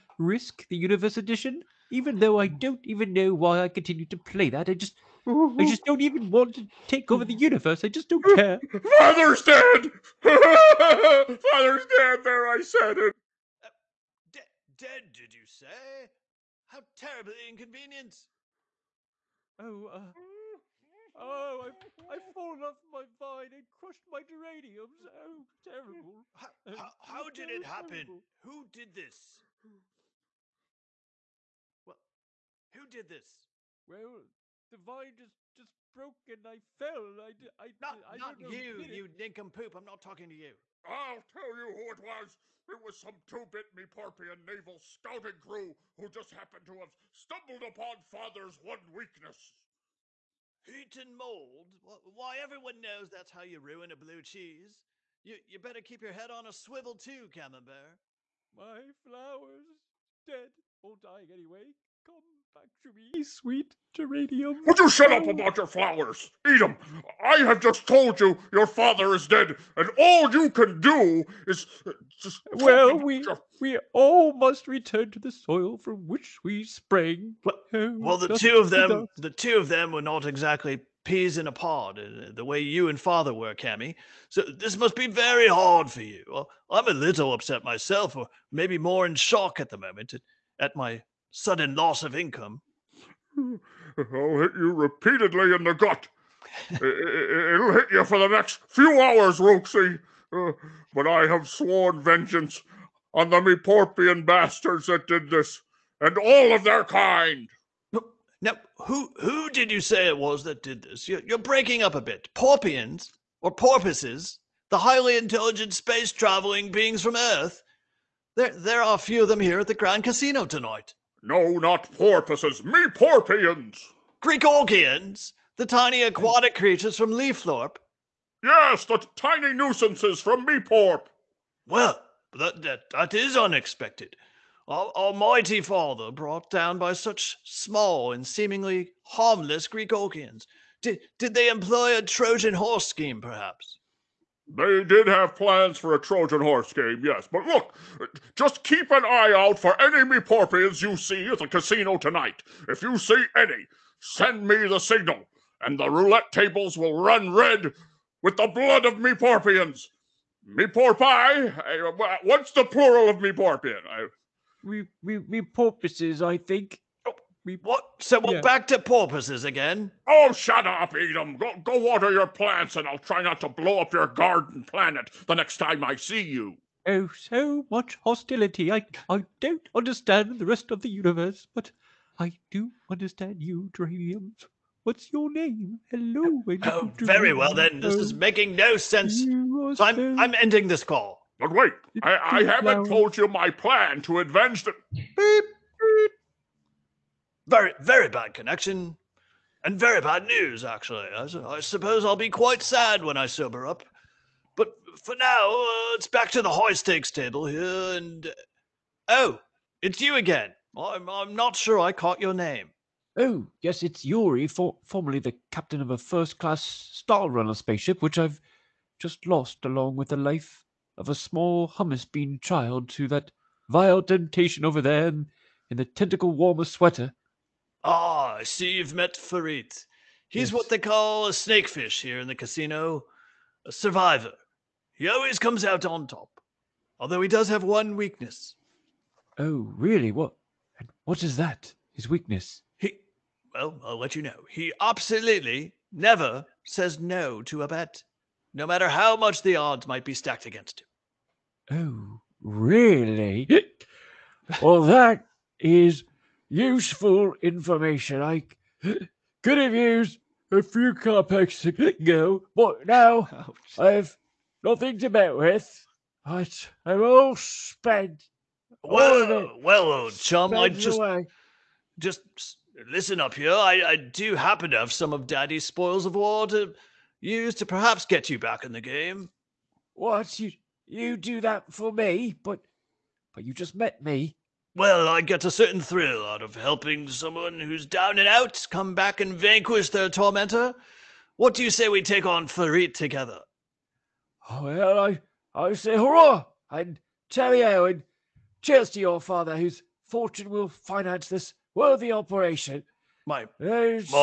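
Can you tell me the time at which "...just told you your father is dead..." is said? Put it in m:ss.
1:07.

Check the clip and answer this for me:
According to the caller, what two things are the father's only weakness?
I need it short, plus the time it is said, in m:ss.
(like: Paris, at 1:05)
Heat and mold, at 0:50.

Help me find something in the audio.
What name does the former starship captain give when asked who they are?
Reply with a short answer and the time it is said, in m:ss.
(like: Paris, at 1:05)
Yuri, at 3:34.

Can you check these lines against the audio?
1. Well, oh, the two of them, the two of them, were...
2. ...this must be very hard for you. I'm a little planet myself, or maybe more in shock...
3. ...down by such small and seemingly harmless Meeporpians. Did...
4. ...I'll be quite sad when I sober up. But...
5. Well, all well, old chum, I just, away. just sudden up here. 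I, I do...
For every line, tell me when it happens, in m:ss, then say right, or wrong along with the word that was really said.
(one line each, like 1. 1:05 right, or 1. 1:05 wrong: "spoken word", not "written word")
1. 1:17 right
2. 1:24 wrong: "upset", not "planet"
3. 2:16 wrong: "Gregorgians", not "Meeporpians"
4. 3:22 right
5. 4:28 wrong: "listen", not "sudden".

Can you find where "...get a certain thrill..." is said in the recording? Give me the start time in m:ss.
4:45.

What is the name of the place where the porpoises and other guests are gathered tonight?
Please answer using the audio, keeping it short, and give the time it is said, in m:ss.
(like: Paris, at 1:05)
Grand Casino, at 1:59.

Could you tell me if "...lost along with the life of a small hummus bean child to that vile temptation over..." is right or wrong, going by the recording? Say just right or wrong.
right.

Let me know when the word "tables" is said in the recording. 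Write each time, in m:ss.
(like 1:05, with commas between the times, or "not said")
2:36, 3:27.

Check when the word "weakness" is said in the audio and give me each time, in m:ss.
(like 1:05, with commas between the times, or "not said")
0:48, 3:57, 4:02.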